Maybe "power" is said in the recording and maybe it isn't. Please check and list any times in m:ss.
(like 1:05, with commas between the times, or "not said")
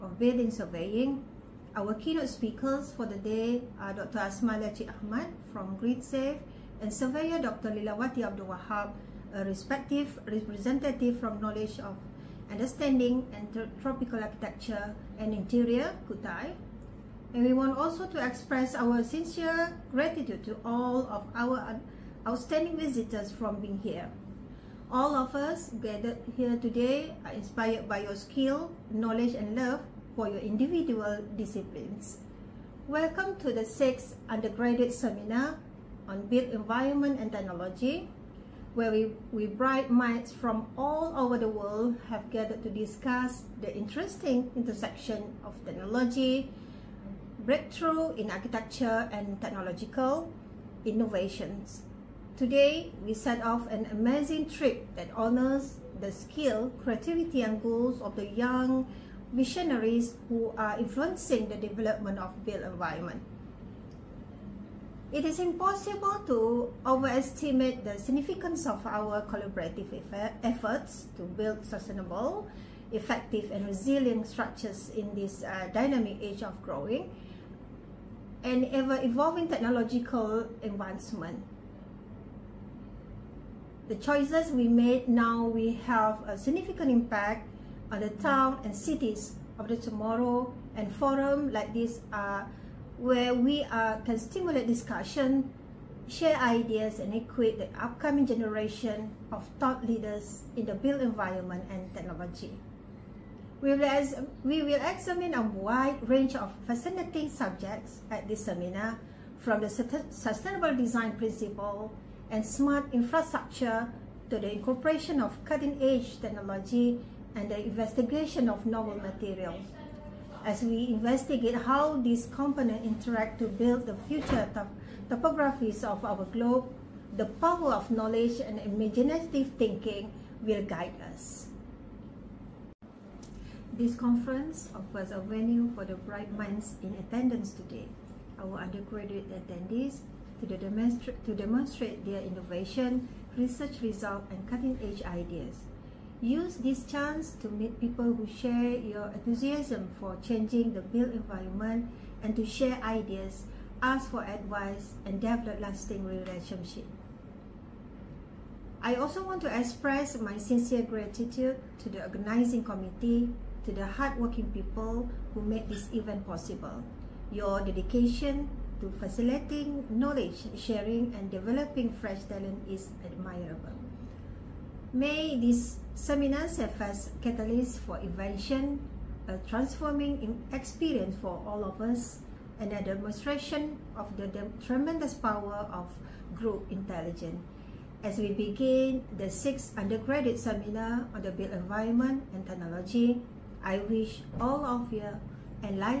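2:07, 3:05.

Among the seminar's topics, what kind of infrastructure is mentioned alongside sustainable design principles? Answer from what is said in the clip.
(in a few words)
smart infrastructure.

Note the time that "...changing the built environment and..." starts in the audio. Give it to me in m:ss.
2:30.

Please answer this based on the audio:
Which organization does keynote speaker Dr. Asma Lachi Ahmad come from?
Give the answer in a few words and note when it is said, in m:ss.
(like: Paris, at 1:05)
GridSafe, at 0:05.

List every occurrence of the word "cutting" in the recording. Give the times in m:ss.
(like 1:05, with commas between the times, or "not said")
1:55, 2:24.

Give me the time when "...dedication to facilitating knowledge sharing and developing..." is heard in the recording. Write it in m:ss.
2:47.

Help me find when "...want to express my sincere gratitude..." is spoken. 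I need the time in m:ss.
2:39.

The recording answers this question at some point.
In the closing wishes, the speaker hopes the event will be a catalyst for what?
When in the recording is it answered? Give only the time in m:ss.
2:57.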